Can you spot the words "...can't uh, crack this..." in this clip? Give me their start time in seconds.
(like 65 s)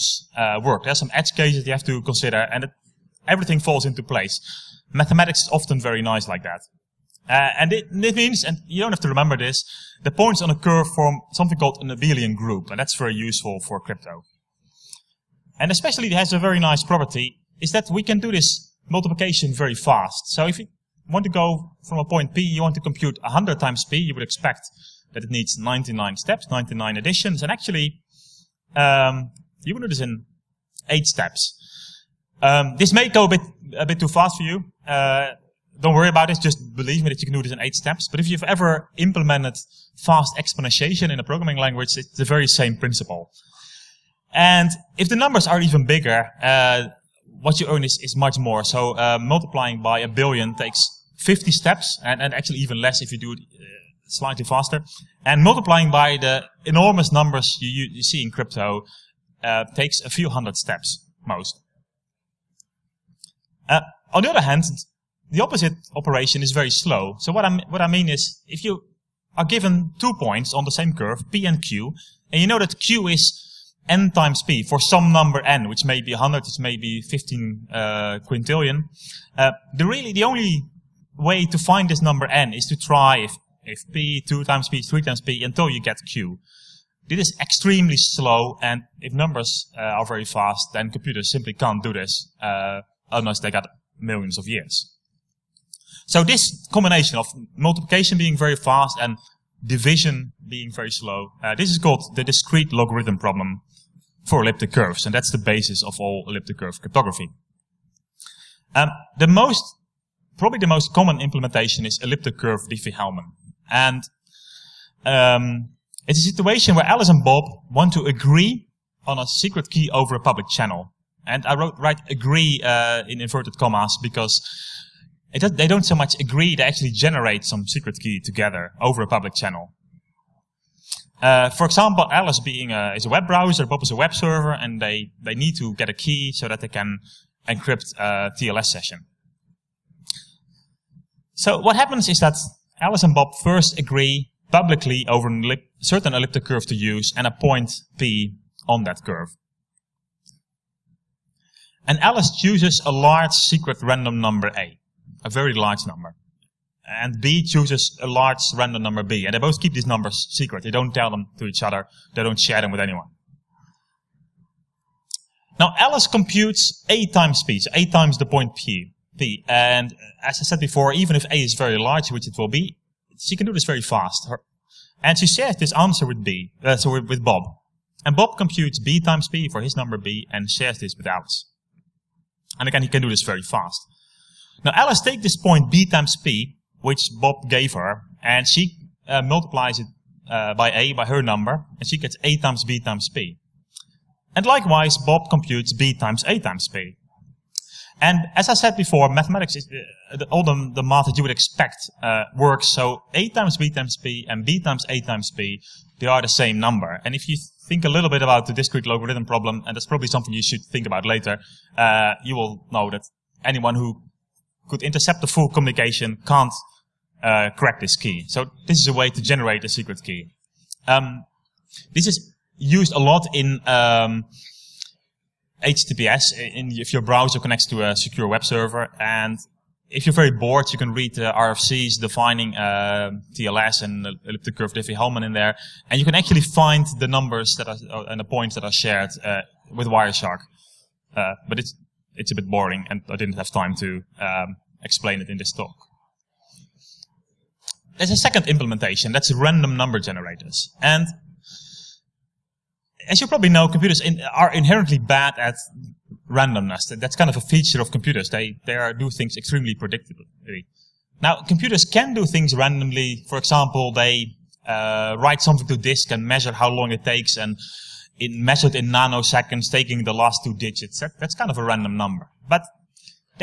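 216 s.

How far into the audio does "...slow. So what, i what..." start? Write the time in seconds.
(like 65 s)
66 s.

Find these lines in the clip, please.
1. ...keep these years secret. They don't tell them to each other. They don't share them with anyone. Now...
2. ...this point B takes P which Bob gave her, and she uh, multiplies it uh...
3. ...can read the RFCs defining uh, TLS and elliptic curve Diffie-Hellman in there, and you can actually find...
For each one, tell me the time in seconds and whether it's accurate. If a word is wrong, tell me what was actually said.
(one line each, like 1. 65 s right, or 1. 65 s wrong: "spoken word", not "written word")
1. 159 s wrong: "numbers", not "years"
2. 185 s wrong: "times", not "takes"
3. 230 s right.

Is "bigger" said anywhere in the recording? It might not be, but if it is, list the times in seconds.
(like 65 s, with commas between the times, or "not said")
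45 s.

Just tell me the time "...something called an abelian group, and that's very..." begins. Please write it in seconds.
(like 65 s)
11 s.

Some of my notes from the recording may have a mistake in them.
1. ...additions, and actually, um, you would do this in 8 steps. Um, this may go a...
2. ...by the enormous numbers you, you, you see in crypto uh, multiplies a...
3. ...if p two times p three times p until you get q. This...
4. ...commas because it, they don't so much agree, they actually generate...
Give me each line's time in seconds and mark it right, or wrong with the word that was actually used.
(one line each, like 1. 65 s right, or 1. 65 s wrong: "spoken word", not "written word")
1. 26 s right
2. 55 s wrong: "takes", not "multiplies"
3. 83 s right
4. 123 s right.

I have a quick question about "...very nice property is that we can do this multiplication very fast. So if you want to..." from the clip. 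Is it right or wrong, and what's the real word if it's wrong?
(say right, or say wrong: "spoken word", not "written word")
right.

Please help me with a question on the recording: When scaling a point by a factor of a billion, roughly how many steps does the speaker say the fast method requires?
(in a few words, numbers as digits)
50.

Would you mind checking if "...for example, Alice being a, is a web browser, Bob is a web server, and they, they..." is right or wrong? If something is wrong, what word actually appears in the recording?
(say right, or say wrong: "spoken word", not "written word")
right.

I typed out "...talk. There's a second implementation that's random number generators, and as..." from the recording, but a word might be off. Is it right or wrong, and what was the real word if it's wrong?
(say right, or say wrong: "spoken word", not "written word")
right.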